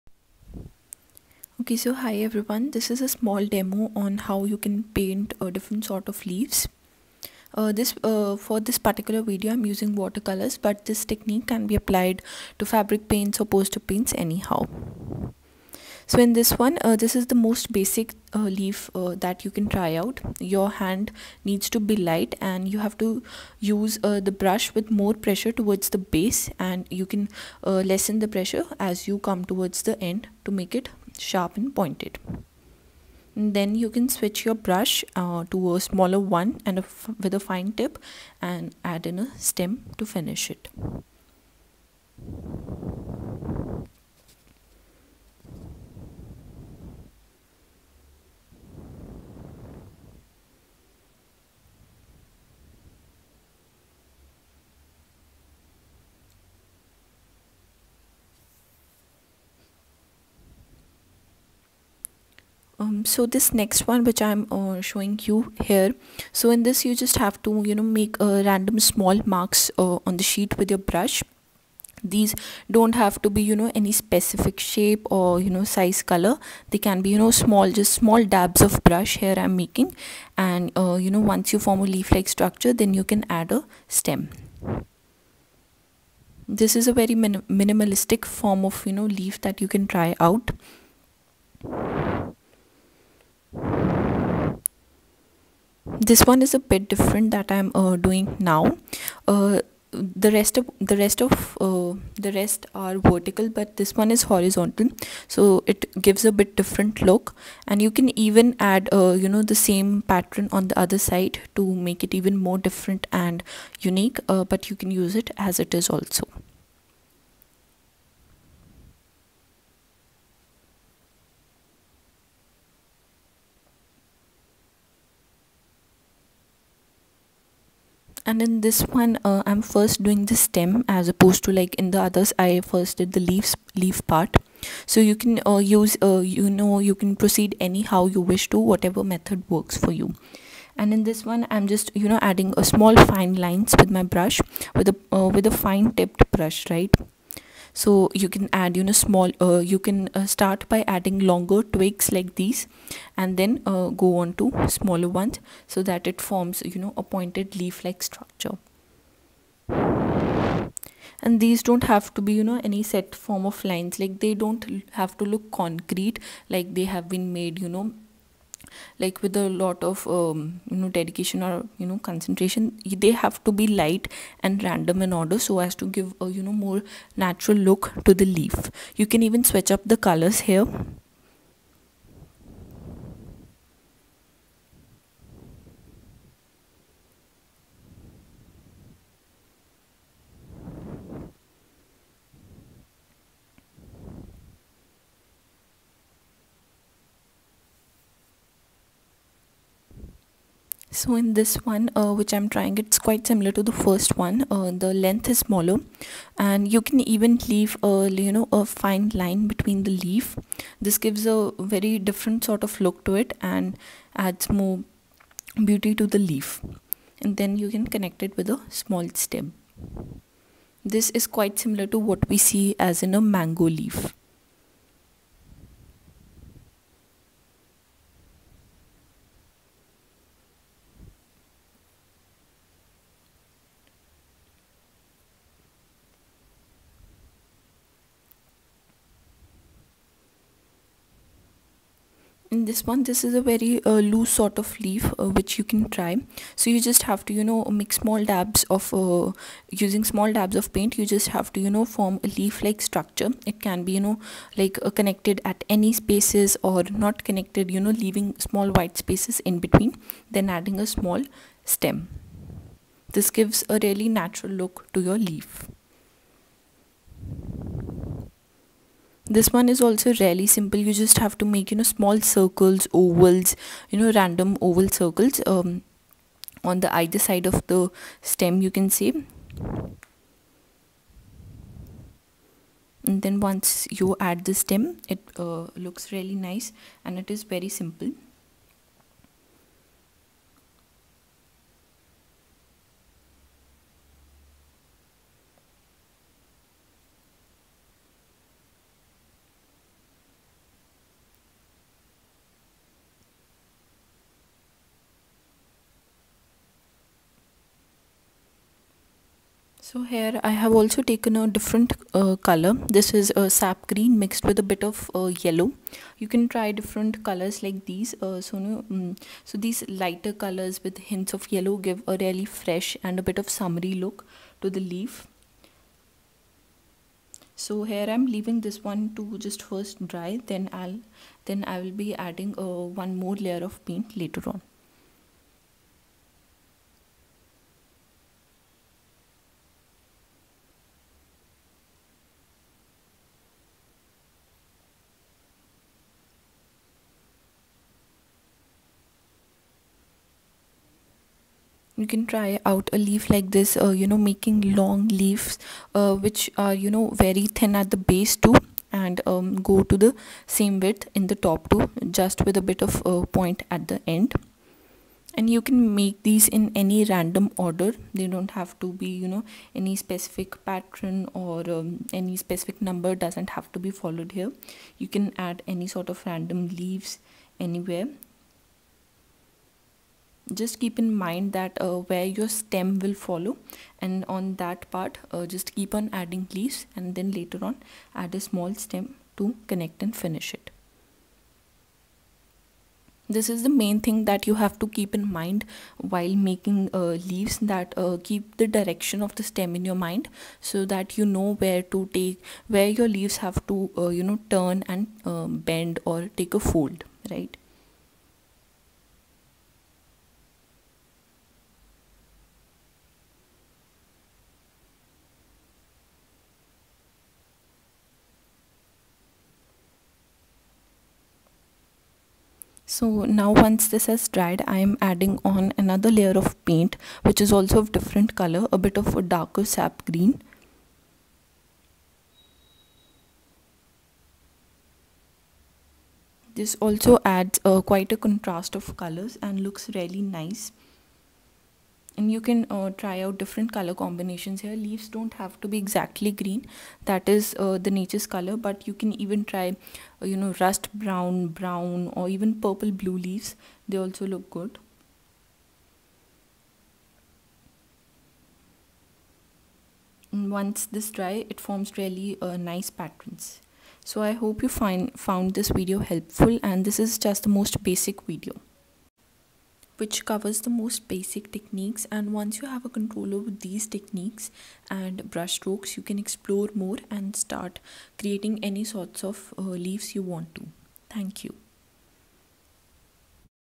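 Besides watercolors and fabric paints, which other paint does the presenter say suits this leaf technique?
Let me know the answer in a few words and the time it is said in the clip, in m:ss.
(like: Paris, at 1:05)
poster paints, at 0:13.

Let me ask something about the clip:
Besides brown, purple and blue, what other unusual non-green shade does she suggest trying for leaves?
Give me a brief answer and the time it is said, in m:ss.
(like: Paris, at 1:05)
rust brown, at 7:30.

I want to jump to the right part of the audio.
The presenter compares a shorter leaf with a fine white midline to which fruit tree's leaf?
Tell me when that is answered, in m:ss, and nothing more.
3:43.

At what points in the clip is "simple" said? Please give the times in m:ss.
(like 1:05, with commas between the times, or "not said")
4:30, 4:47.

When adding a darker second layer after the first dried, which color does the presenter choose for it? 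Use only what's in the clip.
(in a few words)
darker sap green.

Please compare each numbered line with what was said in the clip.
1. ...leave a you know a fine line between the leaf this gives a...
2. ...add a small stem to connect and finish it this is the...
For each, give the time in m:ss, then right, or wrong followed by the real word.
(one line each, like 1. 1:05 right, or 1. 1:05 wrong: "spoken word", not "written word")
1. 3:27 right
2. 6:28 right.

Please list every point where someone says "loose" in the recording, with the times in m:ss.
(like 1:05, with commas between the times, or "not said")
4:04.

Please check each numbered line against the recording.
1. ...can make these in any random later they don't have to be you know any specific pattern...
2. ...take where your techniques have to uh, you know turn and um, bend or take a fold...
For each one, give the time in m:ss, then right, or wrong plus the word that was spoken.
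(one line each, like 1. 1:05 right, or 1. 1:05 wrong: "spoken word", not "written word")
1. 6:05 wrong: "order", not "later"
2. 6:42 wrong: "leaves", not "techniques".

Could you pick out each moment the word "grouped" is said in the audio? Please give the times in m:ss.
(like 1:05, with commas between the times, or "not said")
not said.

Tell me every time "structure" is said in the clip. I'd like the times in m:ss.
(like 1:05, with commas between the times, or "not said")
1:22, 2:38, 4:12.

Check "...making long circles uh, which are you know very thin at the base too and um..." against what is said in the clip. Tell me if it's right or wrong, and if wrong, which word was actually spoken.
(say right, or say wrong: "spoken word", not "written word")
wrong: "leaves", not "circles".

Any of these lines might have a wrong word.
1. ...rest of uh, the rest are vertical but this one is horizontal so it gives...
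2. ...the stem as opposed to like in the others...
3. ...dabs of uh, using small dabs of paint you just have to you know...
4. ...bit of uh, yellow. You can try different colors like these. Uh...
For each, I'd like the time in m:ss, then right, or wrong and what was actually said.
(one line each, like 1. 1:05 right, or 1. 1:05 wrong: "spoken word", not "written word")
1. 1:41 right
2. 2:10 right
3. 4:08 right
4. 5:14 right.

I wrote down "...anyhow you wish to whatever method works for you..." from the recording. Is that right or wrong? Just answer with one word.
right.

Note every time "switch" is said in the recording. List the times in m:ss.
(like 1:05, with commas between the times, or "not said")
0:34, 2:59.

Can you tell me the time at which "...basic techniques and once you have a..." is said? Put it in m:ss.
7:51.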